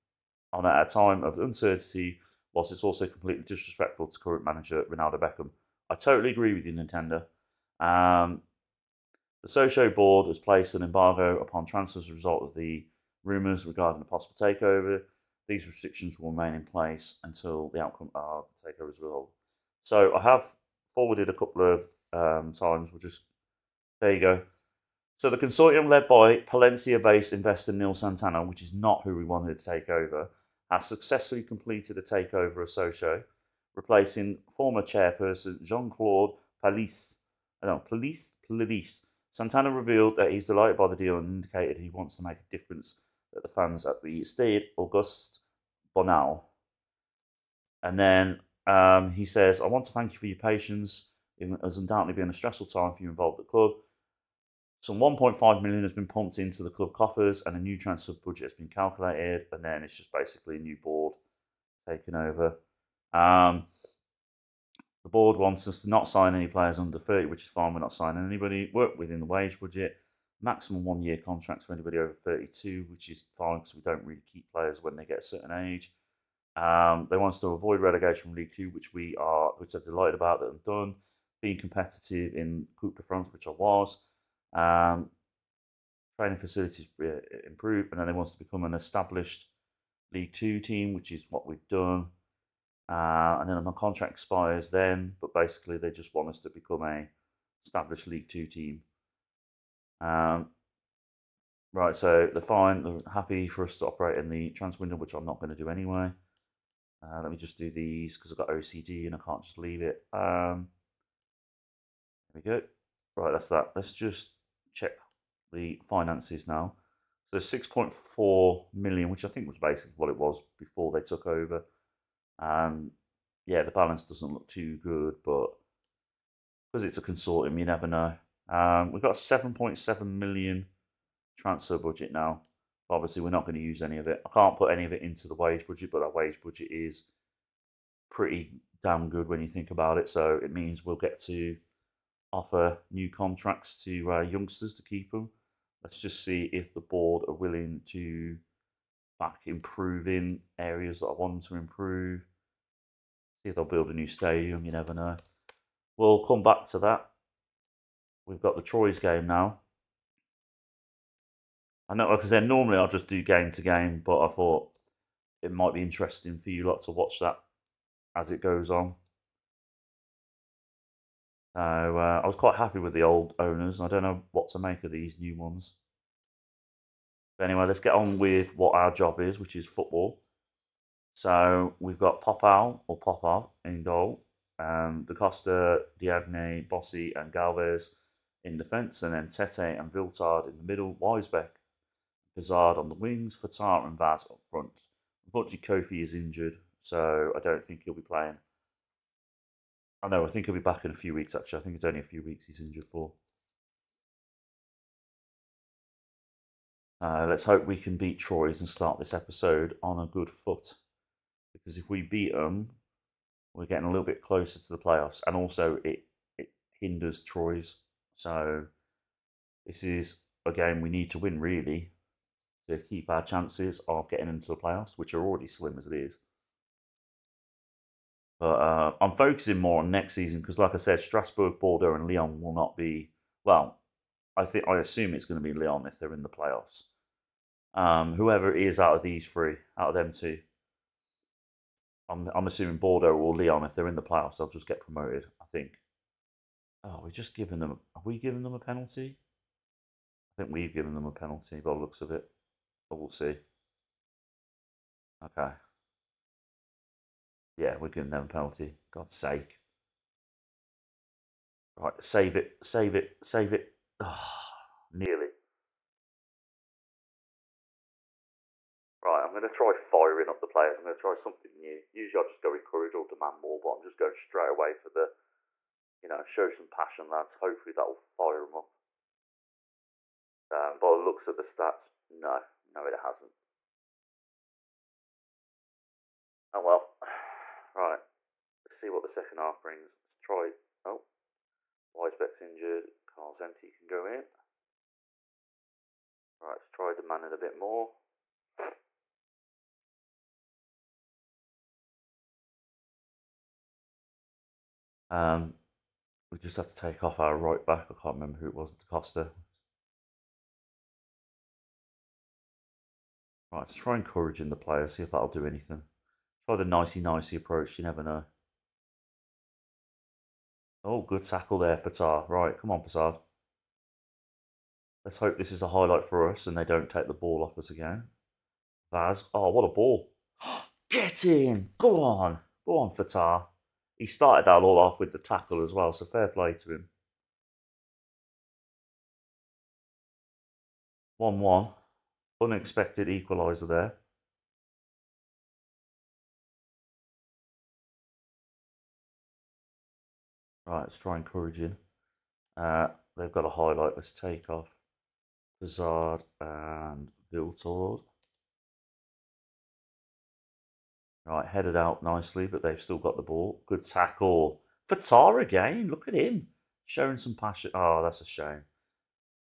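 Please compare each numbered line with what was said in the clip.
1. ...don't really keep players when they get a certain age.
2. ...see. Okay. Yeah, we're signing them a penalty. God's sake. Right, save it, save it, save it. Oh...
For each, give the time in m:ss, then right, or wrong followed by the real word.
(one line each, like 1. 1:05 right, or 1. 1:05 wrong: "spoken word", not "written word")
1. 1:13 right
2. 4:13 wrong: "giving", not "signing".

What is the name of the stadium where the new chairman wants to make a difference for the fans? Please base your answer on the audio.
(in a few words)
Stade Auguste Bonal.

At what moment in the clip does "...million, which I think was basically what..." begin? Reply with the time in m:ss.
1:58.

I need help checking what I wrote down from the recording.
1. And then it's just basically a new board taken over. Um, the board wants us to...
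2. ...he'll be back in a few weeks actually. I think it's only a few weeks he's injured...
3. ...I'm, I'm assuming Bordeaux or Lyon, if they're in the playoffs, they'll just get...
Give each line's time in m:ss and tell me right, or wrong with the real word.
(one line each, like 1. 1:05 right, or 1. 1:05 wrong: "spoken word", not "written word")
1. 0:59 right
2. 3:20 right
3. 4:02 right.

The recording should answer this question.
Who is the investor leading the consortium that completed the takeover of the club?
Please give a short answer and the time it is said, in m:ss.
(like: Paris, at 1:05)
Neil Santana, at 0:27.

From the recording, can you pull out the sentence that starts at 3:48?
But uh, I'm focusing more on next season because, like I said, Strasbourg, Bordeaux, and Lyon will not be.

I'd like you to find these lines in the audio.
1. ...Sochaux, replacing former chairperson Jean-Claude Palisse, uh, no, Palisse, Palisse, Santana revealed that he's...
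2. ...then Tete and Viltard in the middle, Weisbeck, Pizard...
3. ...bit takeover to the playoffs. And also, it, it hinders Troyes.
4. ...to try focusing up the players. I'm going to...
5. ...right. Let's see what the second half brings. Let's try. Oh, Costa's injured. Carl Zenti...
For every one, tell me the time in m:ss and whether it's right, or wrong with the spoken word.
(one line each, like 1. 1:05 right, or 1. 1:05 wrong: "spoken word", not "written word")
1. 0:32 right
2. 3:09 right
3. 3:34 wrong: "closer", not "takeover"
4. 4:29 wrong: "firing", not "focusing"
5. 4:47 wrong: "Weisbeck", not "Costa".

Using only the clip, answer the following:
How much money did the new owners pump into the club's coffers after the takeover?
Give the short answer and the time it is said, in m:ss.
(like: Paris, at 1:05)
1.5 million, at 0:54.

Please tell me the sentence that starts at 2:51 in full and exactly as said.
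So uh, I was quite happy with the old owners.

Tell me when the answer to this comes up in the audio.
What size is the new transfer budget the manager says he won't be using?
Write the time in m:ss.
2:09.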